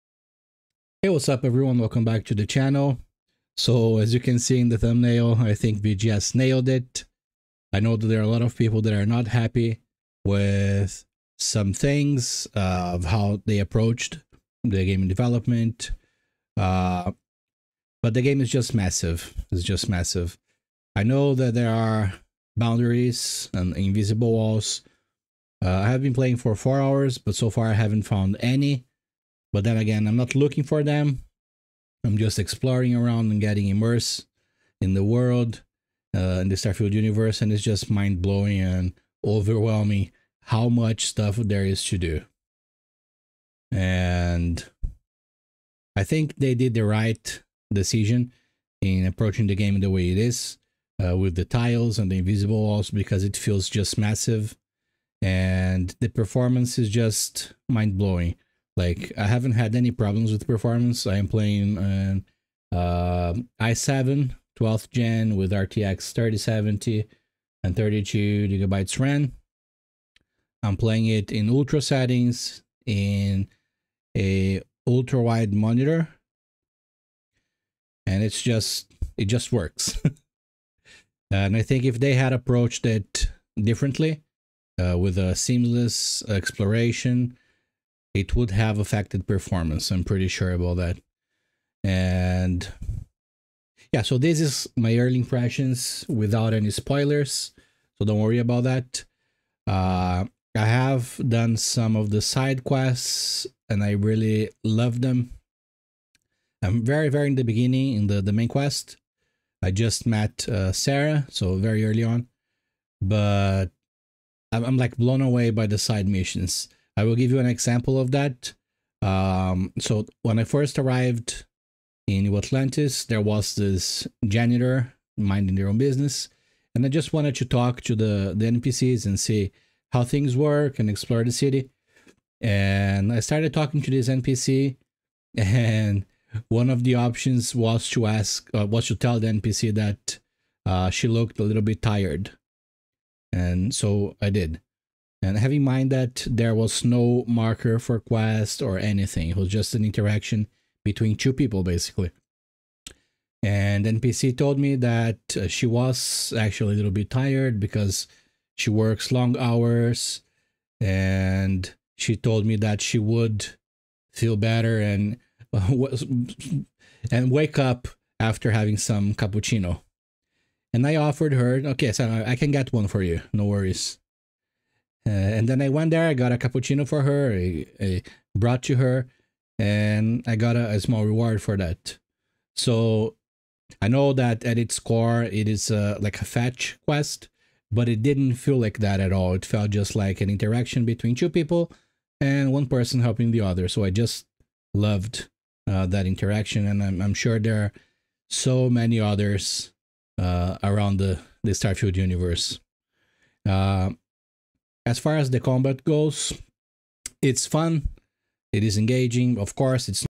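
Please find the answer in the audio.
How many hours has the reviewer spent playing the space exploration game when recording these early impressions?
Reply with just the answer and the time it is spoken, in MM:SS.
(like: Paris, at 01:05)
4, at 00:26.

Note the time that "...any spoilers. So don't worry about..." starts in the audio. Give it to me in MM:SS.
01:36.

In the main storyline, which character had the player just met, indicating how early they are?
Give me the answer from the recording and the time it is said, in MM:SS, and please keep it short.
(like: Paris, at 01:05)
Sarah, at 01:50.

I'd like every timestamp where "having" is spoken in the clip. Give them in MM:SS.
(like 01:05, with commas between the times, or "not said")
02:25, 02:48.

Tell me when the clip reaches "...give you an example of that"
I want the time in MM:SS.
01:57.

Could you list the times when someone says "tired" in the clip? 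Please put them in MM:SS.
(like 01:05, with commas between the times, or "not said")
02:21, 02:37.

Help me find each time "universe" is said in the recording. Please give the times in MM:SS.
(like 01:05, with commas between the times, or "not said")
00:36, 03:21.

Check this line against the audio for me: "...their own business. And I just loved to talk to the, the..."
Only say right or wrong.
wrong.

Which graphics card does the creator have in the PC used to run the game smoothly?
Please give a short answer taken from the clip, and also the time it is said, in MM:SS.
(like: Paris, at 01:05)
RTX 3070, at 01:05.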